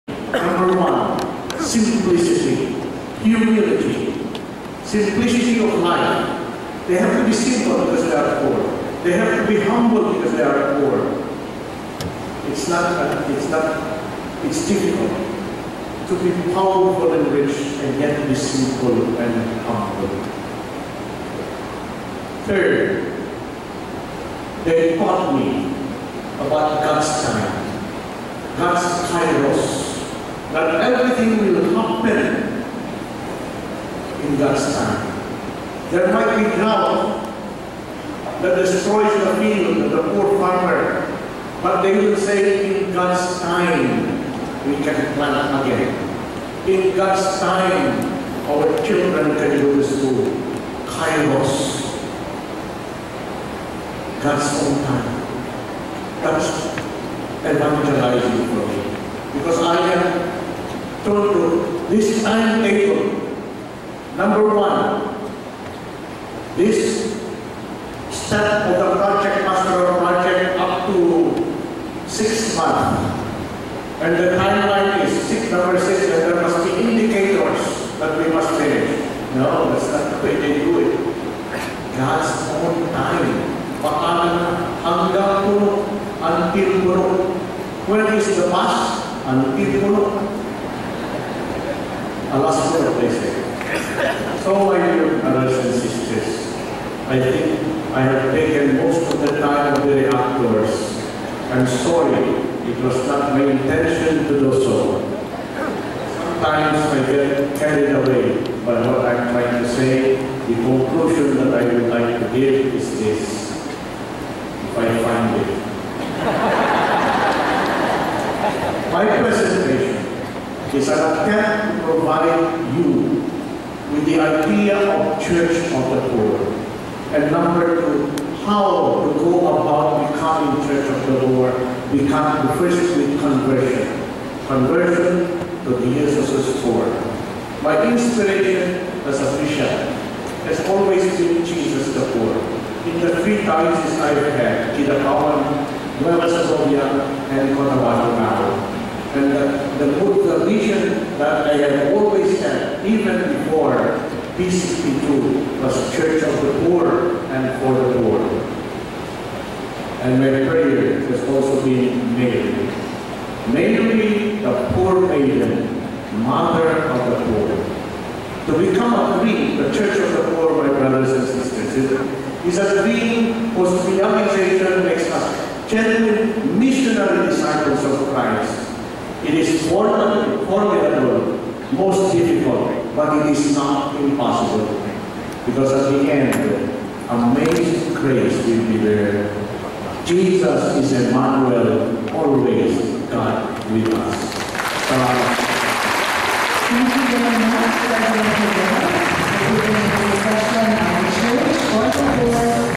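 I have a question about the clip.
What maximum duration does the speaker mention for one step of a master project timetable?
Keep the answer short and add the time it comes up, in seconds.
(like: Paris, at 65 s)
6 months, at 72 s.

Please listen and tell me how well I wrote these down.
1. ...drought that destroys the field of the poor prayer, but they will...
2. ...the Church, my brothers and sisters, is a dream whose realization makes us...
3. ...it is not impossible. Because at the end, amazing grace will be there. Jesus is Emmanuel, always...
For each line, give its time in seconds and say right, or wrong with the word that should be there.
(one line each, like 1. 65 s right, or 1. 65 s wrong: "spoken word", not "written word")
1. 36 s wrong: "farmer", not "prayer"
2. 170 s wrong: "Poor", not "Church"
3. 183 s right.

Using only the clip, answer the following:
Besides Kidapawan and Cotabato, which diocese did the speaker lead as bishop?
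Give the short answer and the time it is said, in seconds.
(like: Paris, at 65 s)
Nueva Segovia, at 146 s.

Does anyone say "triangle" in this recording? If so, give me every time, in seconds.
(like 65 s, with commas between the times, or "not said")
not said.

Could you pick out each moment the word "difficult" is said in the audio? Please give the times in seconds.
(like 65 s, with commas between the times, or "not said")
14 s, 182 s.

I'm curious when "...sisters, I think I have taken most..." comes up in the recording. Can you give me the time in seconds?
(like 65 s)
95 s.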